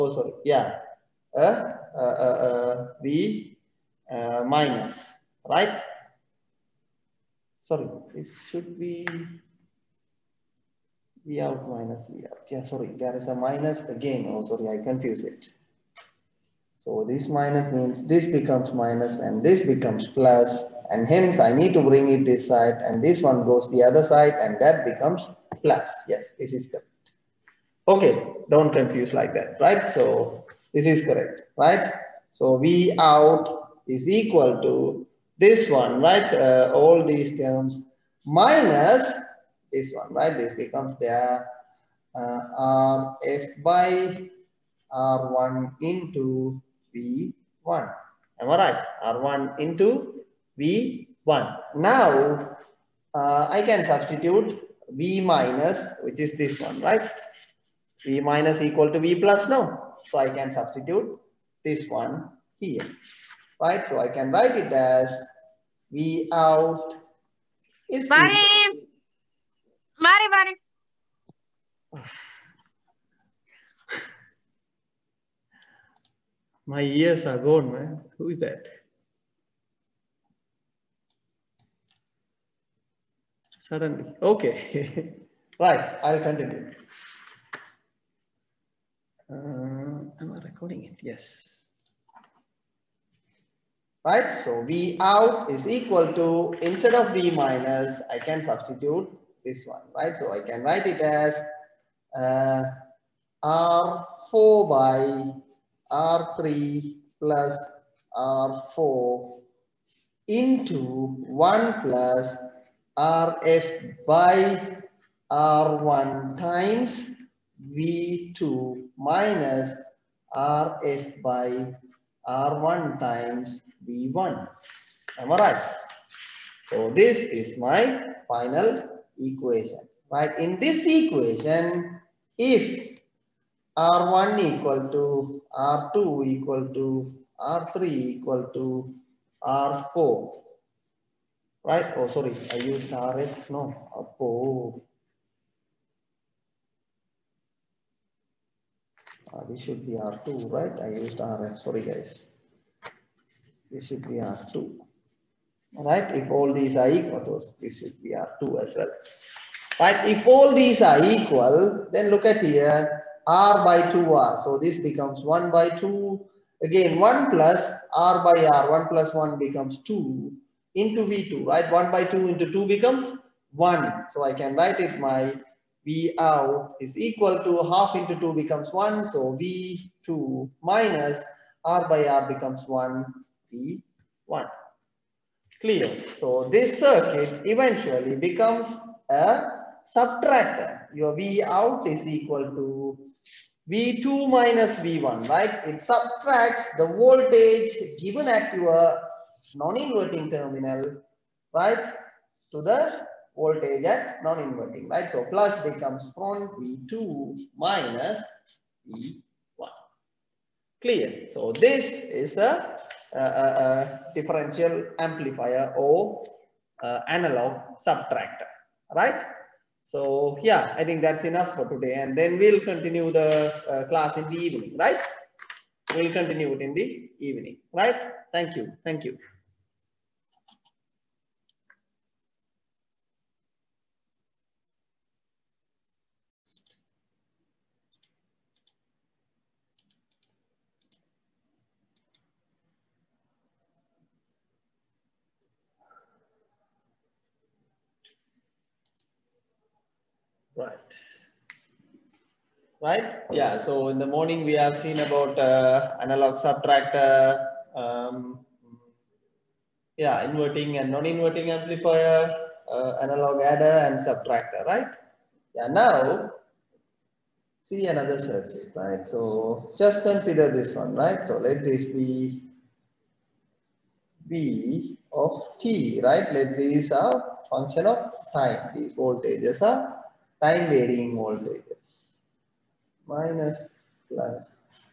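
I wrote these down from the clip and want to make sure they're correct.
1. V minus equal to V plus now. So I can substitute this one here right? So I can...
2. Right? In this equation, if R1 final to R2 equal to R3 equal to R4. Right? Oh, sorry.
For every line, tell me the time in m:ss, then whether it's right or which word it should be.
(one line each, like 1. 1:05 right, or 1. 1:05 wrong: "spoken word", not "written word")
1. 0:58 right
2. 2:10 wrong: "equal", not "final".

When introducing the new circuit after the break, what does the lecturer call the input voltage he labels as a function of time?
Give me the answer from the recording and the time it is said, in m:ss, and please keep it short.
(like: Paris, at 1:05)
V of t, at 4:34.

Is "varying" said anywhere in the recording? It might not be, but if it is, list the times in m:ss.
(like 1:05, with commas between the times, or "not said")
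4:40.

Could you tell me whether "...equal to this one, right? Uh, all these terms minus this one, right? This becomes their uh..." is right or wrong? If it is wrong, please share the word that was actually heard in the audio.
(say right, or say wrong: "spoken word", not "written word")
right.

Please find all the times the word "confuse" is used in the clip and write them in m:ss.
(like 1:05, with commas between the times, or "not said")
0:14, 0:28.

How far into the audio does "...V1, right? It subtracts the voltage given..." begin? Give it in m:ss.
3:14.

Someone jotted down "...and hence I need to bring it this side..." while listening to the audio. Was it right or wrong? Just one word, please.
right.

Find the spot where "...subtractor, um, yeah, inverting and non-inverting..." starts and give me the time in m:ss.
4:16.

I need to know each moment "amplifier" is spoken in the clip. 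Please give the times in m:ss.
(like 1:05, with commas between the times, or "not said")
3:34, 4:21.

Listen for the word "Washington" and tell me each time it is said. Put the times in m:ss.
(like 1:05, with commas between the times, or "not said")
not said.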